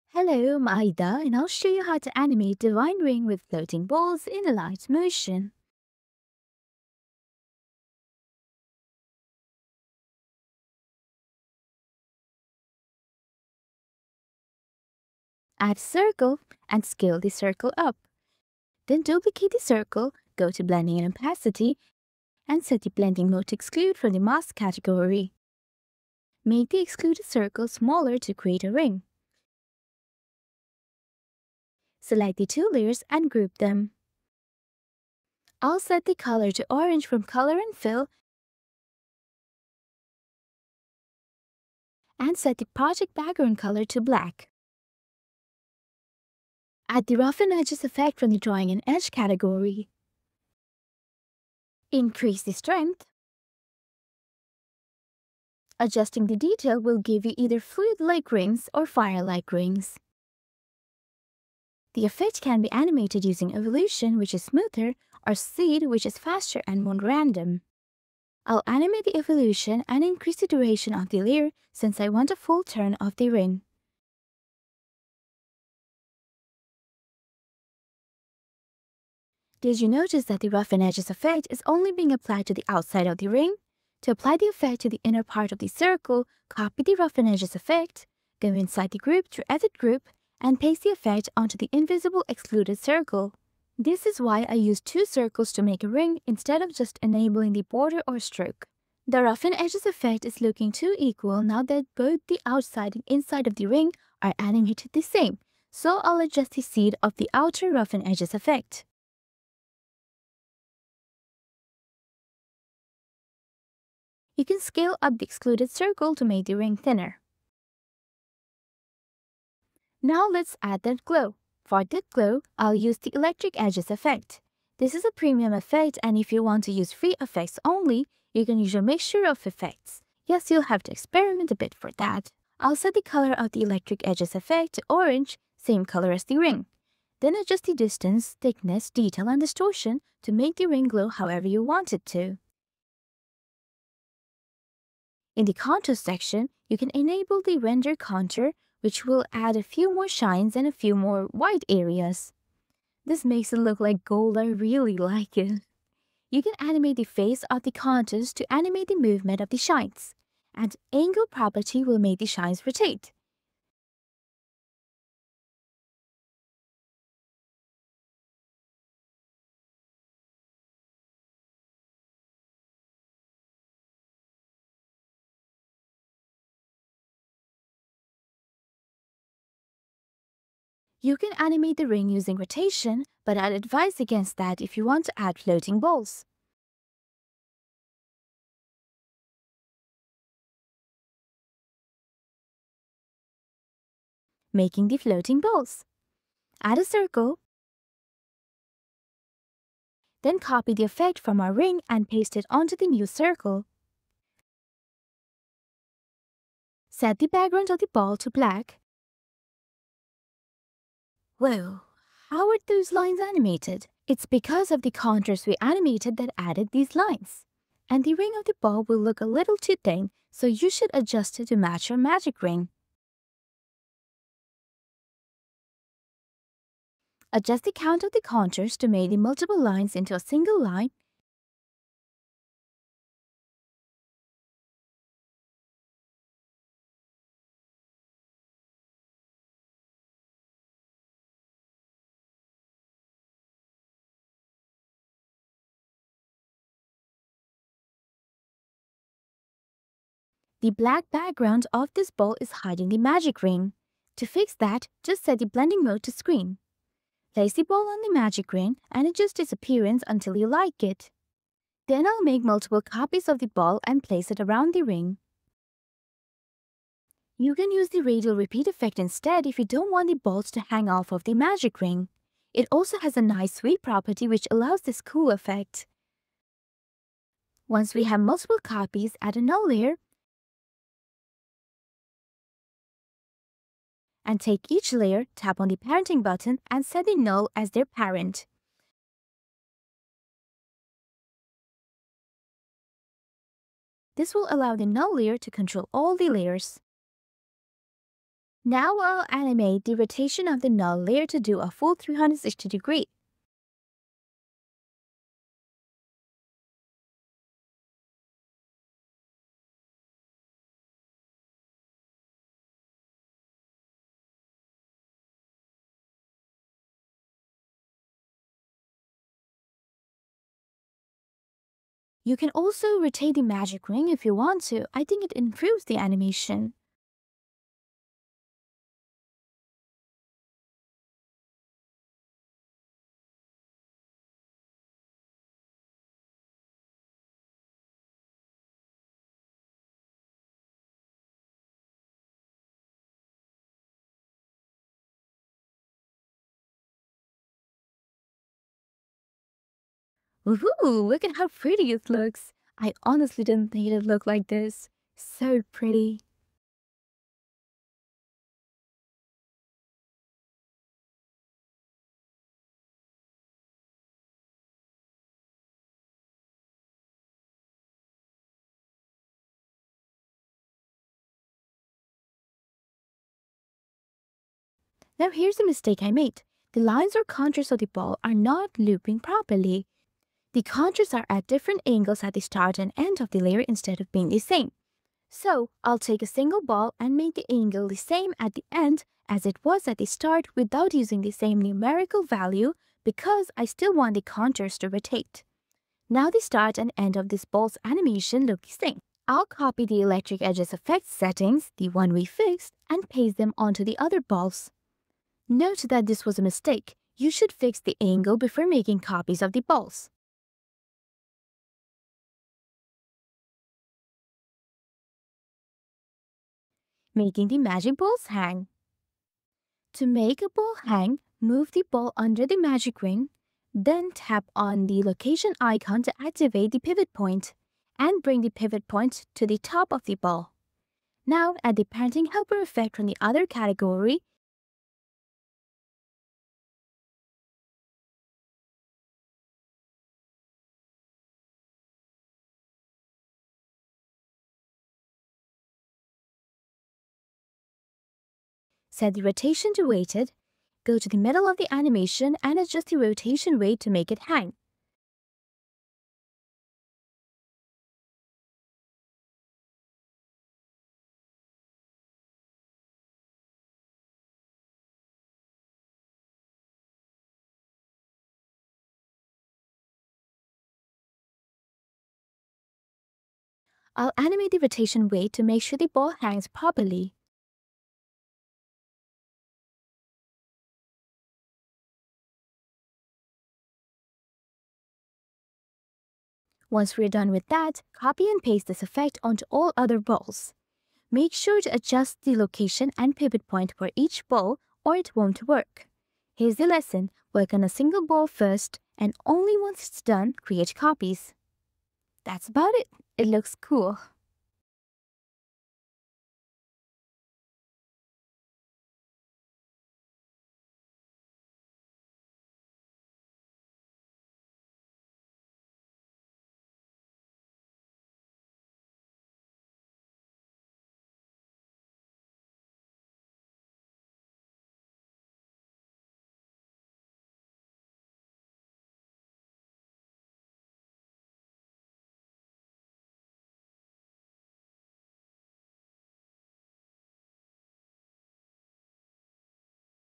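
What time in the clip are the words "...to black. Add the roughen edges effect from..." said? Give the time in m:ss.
0:43.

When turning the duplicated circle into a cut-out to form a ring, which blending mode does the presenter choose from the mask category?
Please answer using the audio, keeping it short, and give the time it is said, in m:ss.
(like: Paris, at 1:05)
Exclude, at 0:23.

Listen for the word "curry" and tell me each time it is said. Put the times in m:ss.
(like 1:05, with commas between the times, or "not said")
not said.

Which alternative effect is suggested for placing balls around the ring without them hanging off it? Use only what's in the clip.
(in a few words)
Radial repeat.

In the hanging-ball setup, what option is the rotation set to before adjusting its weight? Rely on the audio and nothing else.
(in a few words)
Weighted.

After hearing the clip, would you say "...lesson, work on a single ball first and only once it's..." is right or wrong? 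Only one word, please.
right.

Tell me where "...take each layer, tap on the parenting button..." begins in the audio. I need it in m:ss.
4:44.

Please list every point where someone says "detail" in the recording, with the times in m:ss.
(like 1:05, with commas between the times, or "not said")
0:56, 2:18.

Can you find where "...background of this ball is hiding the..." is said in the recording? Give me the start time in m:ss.
4:11.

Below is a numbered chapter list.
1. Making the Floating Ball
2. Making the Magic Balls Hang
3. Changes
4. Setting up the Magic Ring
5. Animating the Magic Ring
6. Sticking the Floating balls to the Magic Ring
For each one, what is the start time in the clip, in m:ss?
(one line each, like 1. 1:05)
1. 3:14
2. 6:56
3. 8:43
4. 0:15
5. 0:46
6. 4:20.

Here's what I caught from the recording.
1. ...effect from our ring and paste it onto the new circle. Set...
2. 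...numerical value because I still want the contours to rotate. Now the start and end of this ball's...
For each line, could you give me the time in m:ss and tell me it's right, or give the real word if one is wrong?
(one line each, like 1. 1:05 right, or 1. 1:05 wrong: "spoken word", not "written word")
1. 3:20 right
2. 6:31 right.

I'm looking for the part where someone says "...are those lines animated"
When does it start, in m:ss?
3:32.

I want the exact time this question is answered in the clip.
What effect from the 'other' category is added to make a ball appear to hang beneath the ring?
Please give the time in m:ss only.
7:11.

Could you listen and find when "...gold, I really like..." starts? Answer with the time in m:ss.
2:34.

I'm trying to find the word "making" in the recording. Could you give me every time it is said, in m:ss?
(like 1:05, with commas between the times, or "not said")
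3:14, 6:48, 6:57.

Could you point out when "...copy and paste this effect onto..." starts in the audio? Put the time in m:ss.
8:07.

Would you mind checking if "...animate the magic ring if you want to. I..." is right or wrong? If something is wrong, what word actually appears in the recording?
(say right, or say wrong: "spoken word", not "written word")
wrong: "rotate", not "animate".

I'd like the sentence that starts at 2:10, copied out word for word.
Yes, you'll have to experiment a bit for that.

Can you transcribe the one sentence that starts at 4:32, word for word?
It also has a nice sweep property which allows this cool effect.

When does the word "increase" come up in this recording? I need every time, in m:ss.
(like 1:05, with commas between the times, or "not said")
0:51, 1:10.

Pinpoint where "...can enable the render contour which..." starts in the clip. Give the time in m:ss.
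2:26.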